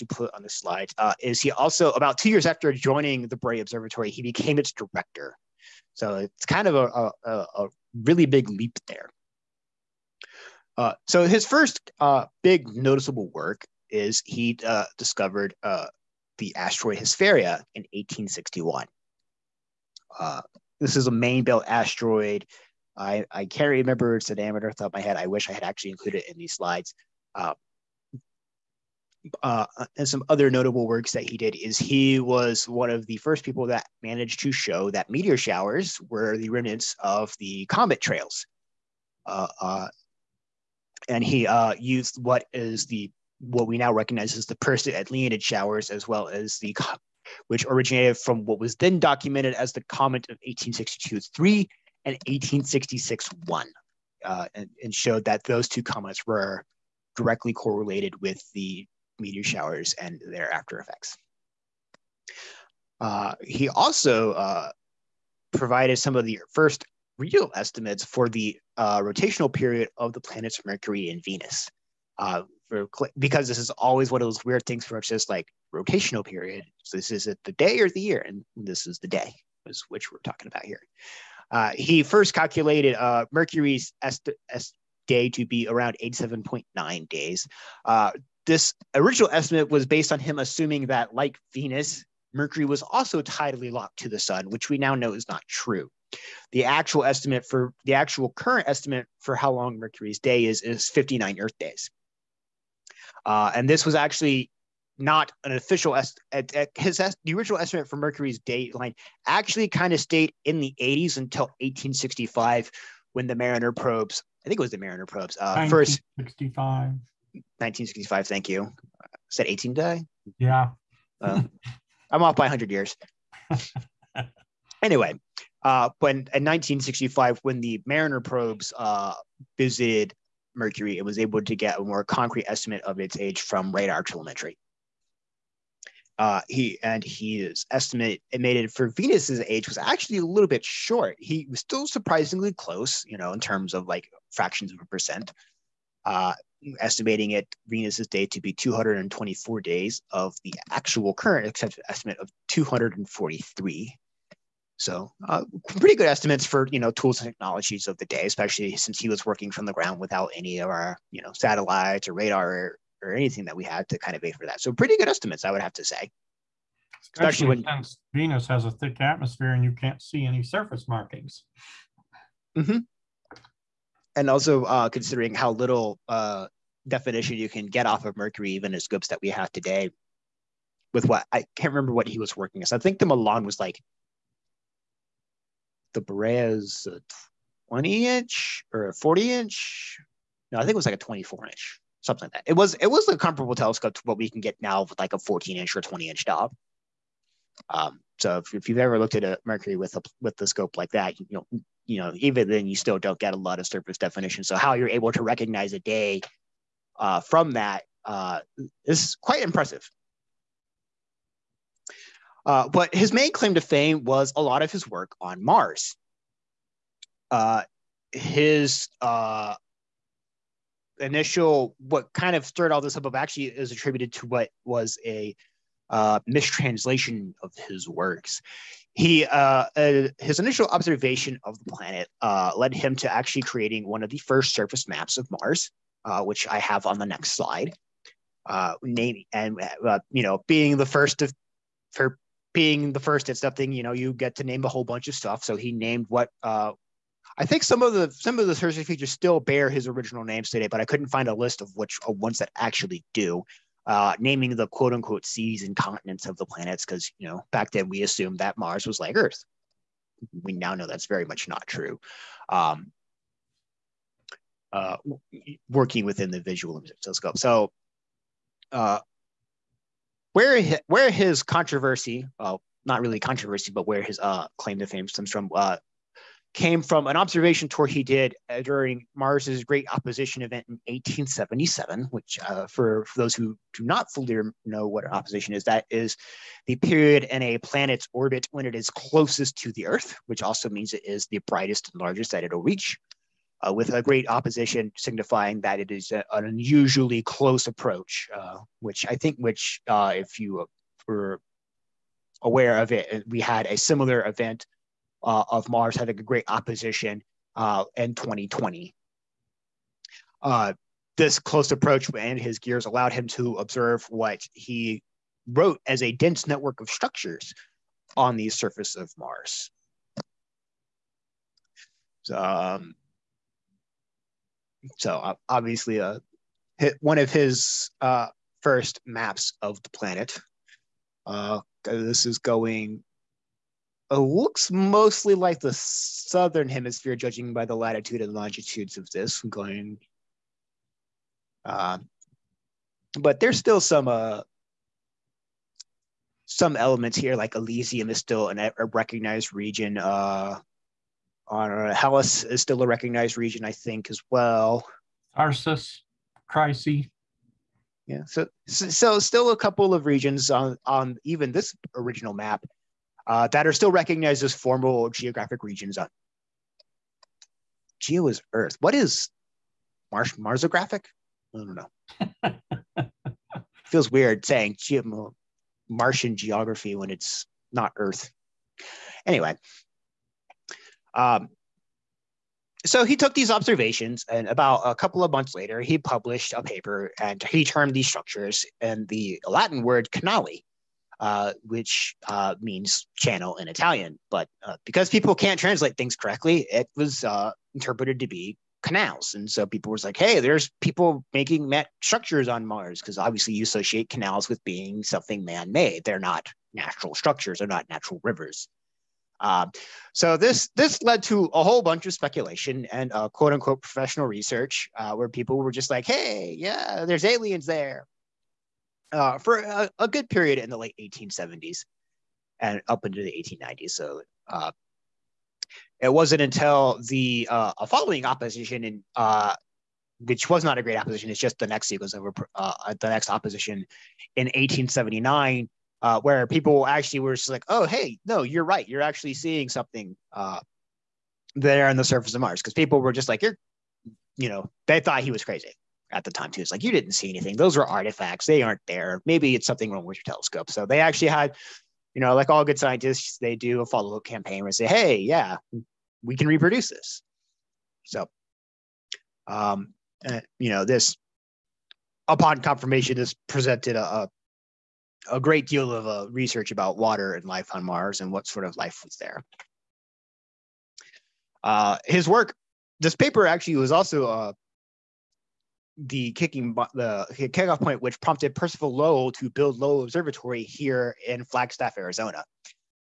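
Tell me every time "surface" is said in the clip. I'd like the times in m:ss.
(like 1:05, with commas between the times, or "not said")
2:50, 3:23, 3:54, 5:18, 7:22.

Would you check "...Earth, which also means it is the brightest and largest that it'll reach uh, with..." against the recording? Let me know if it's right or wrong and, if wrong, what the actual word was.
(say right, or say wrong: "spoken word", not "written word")
right.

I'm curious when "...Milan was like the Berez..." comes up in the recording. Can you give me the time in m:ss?
3:03.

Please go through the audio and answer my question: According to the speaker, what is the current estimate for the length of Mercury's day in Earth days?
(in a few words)
59.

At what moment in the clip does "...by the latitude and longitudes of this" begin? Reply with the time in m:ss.
5:37.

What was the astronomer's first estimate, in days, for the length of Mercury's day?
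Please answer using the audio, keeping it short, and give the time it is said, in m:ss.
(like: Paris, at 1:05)
87.9 days, at 1:26.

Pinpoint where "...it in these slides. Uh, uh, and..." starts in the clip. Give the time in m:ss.
0:26.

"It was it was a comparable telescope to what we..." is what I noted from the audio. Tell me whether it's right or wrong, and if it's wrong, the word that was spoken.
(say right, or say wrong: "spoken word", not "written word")
right.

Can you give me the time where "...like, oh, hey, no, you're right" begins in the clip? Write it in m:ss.
7:17.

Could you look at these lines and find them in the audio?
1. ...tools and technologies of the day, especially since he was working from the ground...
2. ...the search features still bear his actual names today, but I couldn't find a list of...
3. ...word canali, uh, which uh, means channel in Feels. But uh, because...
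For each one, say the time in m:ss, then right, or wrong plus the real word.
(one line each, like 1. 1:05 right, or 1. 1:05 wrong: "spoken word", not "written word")
1. 2:36 right
2. 4:08 wrong: "original", not "actual"
3. 6:29 wrong: "Italian", not "Feels".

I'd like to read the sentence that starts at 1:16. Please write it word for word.
So this is it the day or the year, and this is the day, is which we're talking about here.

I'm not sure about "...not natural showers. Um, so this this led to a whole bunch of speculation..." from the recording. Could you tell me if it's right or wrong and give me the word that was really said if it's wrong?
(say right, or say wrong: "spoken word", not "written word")
wrong: "rivers", not "showers".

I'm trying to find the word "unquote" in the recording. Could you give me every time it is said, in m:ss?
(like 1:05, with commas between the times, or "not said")
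4:14, 6:53.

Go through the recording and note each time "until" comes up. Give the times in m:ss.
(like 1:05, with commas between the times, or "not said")
1:51, 7:06.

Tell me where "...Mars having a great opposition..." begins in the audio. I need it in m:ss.
5:05.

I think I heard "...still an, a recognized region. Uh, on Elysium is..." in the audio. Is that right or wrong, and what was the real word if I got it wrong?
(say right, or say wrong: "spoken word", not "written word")
wrong: "Hellas", not "Elysium".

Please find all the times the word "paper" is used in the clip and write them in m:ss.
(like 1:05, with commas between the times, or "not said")
6:26, 7:53.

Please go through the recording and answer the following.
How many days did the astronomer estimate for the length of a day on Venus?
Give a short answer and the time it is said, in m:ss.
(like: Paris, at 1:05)
224, at 2:28.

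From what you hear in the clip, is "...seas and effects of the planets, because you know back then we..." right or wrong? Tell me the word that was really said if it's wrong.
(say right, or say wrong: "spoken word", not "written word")
wrong: "continents", not "effects".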